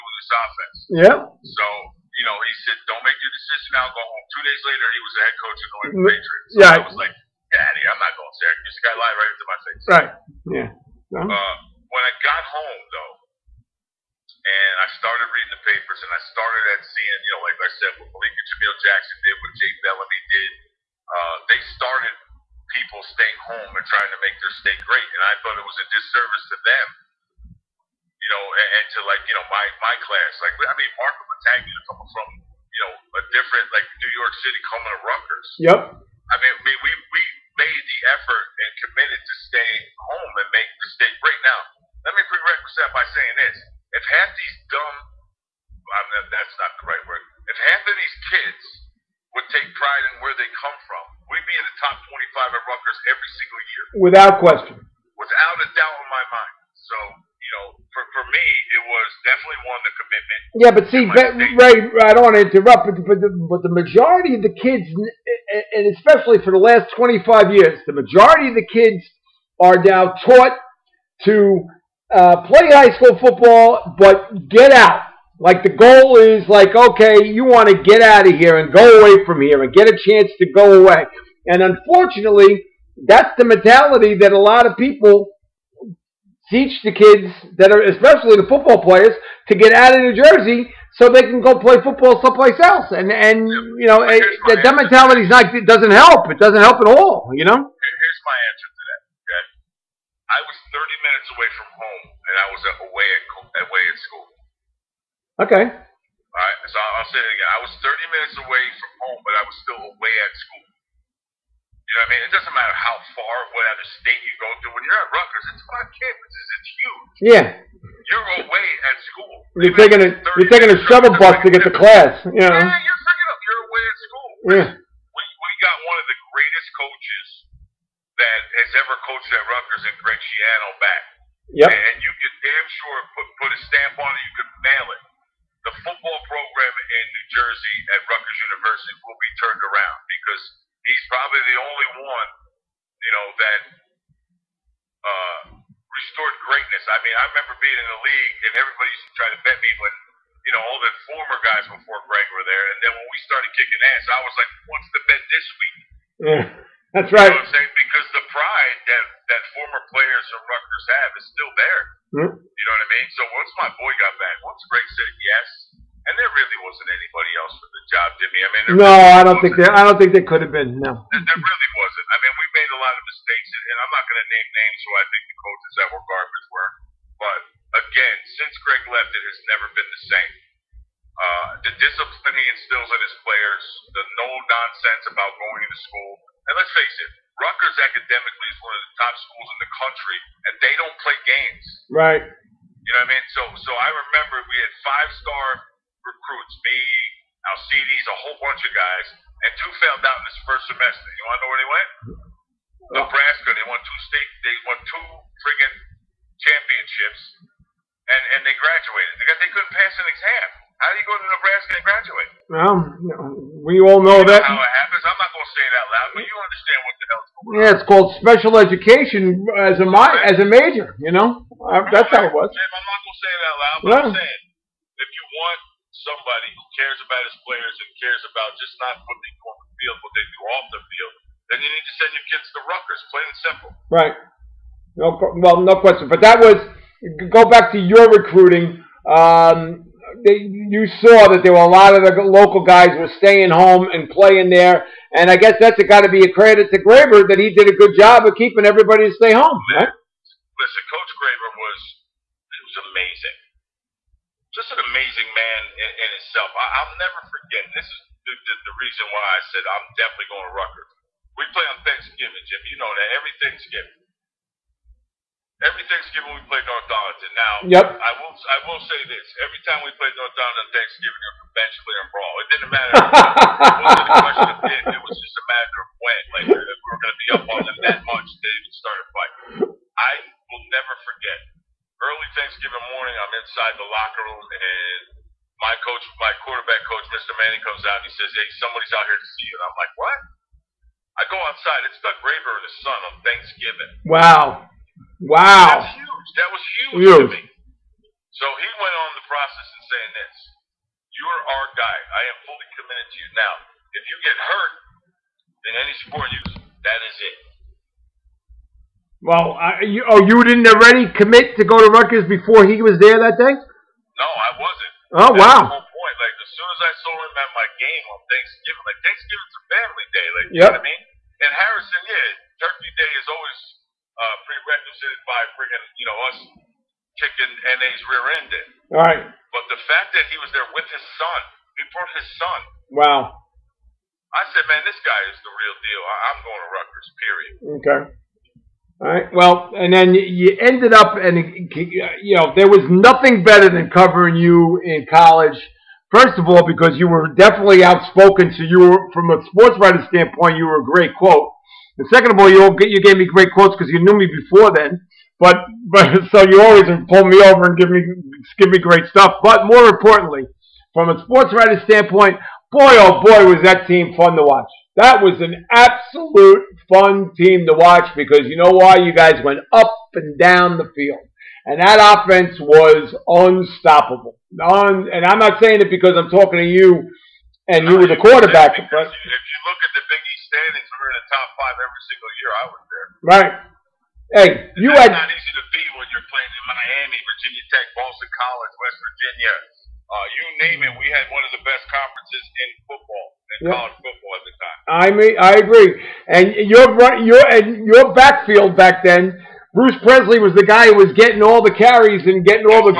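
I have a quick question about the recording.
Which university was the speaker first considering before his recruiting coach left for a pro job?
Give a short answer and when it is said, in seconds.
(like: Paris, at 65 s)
Syracuse, at 8 s.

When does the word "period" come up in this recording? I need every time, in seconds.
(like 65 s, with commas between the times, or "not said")
337 s.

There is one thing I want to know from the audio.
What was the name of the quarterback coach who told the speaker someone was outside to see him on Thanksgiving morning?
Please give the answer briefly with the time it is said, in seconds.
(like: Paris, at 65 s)
Mr. Manning, at 287 s.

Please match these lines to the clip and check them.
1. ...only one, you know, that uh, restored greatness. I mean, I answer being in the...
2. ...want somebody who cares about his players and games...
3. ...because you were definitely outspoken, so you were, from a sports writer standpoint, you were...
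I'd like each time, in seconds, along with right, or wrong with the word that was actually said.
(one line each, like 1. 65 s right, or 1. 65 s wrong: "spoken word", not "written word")
1. 141 s wrong: "remember", not "answer"
2. 225 s wrong: "cares", not "games"
3. 346 s right.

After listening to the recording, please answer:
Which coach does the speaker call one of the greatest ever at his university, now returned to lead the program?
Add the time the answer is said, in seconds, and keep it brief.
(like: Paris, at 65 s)
Greg Schiano, at 130 s.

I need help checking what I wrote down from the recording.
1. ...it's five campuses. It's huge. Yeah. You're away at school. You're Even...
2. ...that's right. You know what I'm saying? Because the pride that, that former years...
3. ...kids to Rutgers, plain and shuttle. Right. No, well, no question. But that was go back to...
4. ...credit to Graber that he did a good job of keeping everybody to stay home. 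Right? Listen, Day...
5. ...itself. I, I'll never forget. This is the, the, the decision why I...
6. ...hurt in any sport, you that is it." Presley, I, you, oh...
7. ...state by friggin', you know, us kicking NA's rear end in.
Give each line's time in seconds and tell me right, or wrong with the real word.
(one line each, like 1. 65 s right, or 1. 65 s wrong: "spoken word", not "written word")
1. 115 s right
2. 156 s wrong: "players", not "years"
3. 232 s wrong: "simple", not "shuttle"
4. 246 s wrong: "Coach", not "Day"
5. 256 s wrong: "reason", not "decision"
6. 304 s wrong: "Well", not "Presley"
7. 324 s wrong: "prerequisite", not "state".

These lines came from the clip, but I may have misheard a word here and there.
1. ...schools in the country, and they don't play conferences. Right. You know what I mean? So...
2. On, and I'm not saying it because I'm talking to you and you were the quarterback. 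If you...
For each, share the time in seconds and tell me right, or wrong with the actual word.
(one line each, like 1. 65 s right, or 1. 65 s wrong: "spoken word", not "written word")
1. 189 s wrong: "games", not "conferences"
2. 374 s right.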